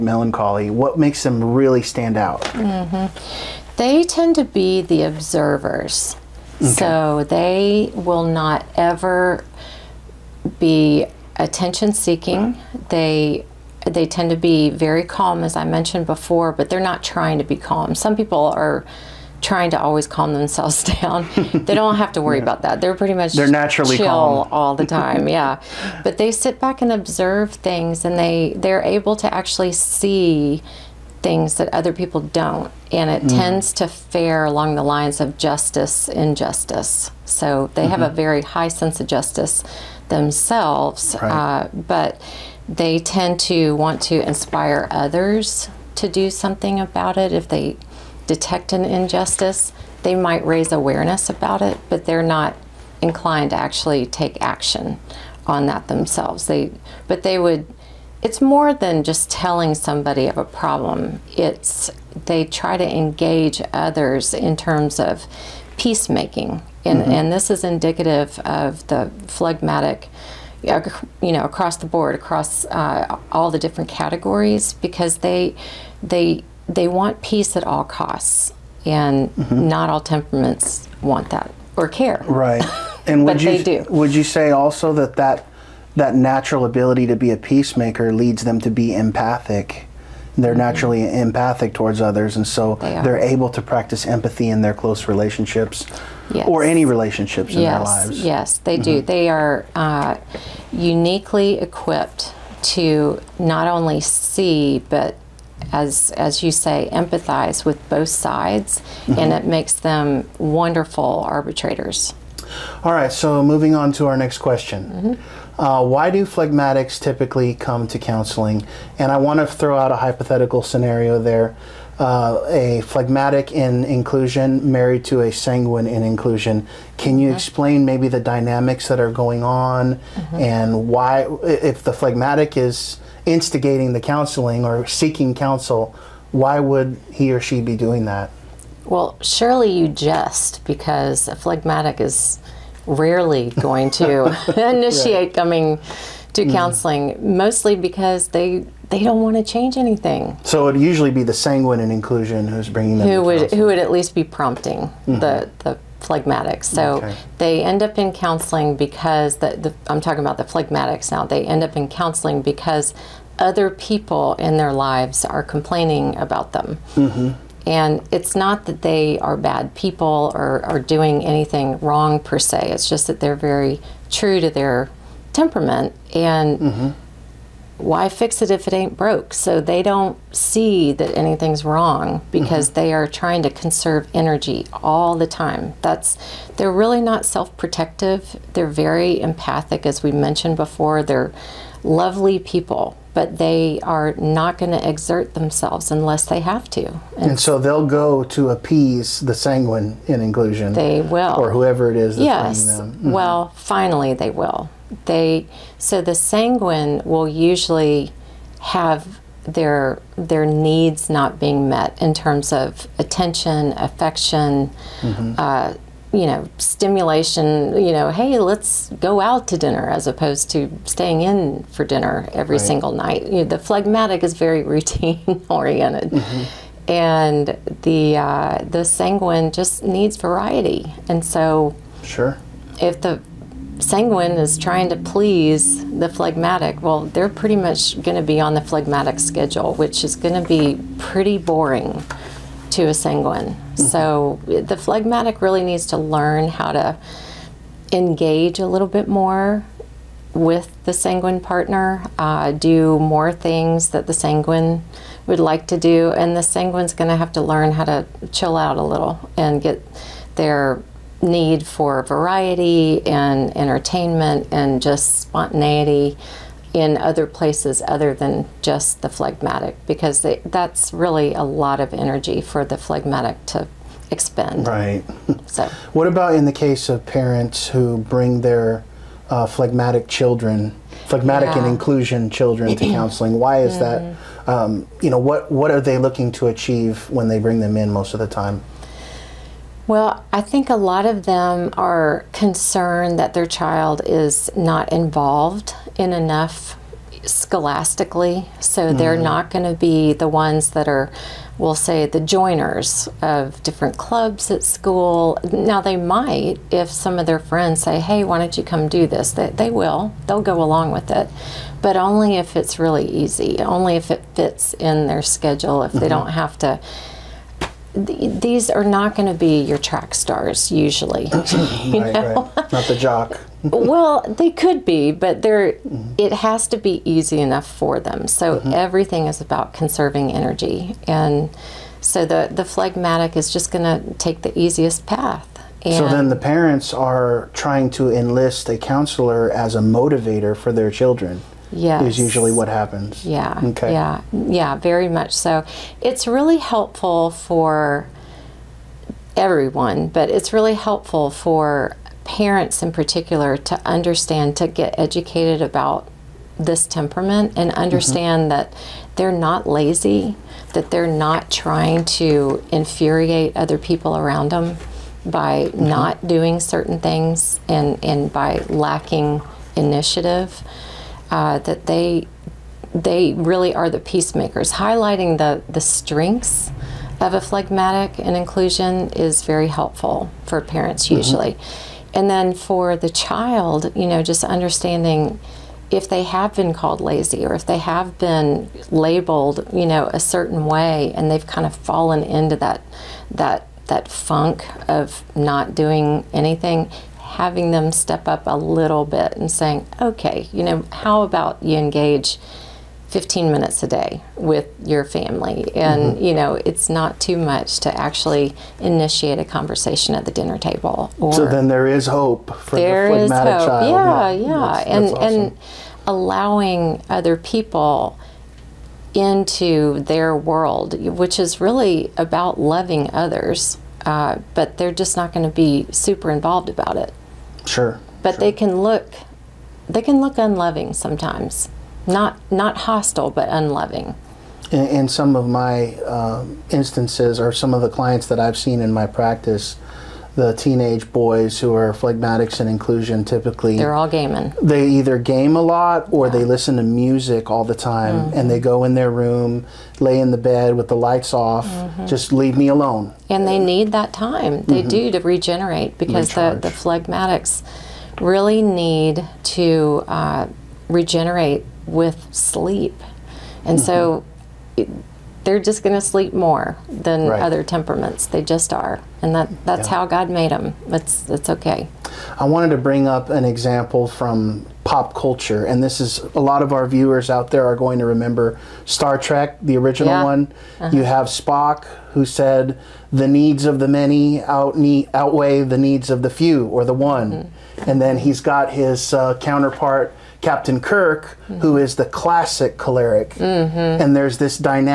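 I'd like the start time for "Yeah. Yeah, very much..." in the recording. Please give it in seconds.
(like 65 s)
343 s.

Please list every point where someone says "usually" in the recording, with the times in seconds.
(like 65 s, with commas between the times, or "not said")
150 s, 207 s, 320 s, 342 s, 381 s.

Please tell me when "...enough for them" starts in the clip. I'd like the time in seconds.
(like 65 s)
327 s.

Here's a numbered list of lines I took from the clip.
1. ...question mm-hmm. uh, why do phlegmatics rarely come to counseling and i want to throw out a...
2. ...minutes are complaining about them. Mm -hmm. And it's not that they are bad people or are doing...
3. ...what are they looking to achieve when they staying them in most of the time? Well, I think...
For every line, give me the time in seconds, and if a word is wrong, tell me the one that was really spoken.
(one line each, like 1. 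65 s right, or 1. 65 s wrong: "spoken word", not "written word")
1. 114 s wrong: "typically", not "rarely"
2. 164 s wrong: "lives", not "minutes"
3. 285 s wrong: "bring", not "staying".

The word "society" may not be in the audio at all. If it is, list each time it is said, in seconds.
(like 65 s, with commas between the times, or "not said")
not said.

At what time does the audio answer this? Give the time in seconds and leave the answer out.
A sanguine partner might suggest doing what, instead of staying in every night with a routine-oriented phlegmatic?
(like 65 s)
219 s.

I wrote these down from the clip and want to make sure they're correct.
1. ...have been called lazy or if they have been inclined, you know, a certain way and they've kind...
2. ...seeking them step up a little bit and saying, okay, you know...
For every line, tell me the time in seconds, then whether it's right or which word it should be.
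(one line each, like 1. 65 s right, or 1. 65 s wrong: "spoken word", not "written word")
1. 386 s wrong: "labeled", not "inclined"
2. 397 s wrong: "having", not "seeking".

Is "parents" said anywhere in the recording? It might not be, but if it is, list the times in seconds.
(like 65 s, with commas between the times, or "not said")
277 s, 336 s, 352 s, 380 s.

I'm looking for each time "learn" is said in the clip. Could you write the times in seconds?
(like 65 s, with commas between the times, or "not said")
245 s, 257 s.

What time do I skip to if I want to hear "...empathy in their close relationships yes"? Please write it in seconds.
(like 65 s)
94 s.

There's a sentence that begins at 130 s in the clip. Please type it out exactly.
and why, if the phlegmatic is instigating the counseling or seeking counsel, why would he or she be doing that?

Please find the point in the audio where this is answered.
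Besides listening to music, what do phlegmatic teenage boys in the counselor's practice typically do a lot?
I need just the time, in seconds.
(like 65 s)
444 s.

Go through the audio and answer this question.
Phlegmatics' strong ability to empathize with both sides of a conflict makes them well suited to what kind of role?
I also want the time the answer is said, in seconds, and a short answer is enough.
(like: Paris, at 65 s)
arbitrators, at 111 s.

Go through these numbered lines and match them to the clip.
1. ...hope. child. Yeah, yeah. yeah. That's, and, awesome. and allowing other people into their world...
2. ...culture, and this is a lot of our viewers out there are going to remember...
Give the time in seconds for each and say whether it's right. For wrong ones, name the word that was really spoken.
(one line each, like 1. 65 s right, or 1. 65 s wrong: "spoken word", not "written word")
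1. 413 s right
2. 475 s right.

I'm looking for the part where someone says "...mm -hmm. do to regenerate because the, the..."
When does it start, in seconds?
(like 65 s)
454 s.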